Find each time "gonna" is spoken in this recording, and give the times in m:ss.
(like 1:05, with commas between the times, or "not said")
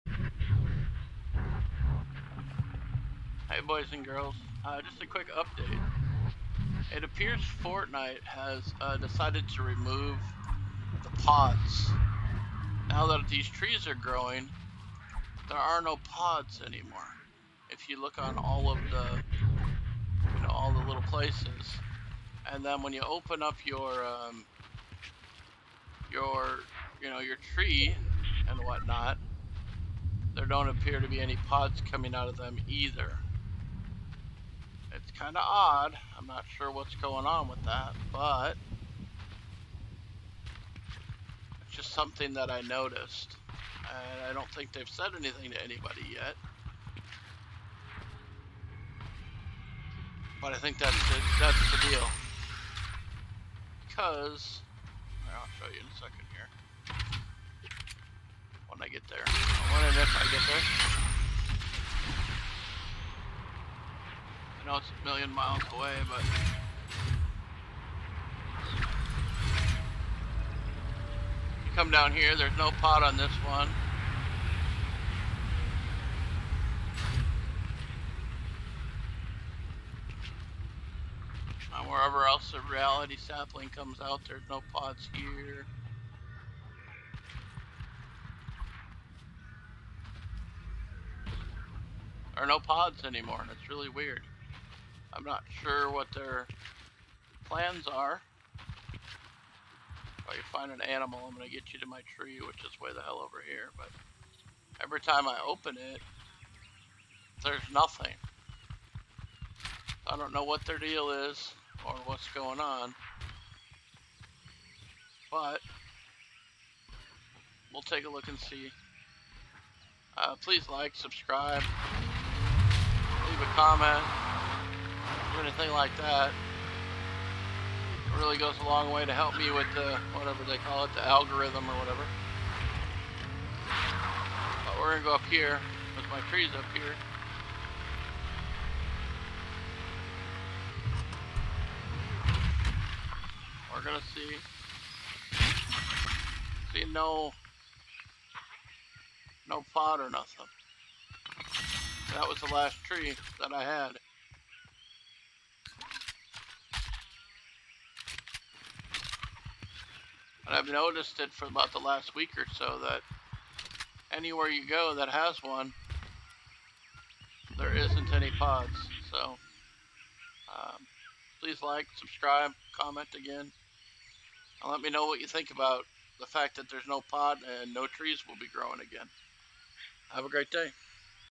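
2:14, 2:23.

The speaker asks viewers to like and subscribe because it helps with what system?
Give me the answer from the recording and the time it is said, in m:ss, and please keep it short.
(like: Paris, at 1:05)
The algorithm, at 2:10.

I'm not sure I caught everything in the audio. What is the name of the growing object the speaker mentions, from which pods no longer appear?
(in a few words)
Reality sapling.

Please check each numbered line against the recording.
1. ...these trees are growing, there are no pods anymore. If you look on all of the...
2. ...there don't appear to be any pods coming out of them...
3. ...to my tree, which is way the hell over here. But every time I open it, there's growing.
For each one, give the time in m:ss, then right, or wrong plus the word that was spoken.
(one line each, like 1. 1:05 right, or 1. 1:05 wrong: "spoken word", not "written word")
1. 0:13 right
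2. 0:30 right
3. 1:41 wrong: "nothing", not "growing".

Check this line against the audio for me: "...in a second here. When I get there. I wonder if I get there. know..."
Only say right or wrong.
right.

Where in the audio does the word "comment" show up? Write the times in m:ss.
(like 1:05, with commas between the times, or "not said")
2:03, 2:52.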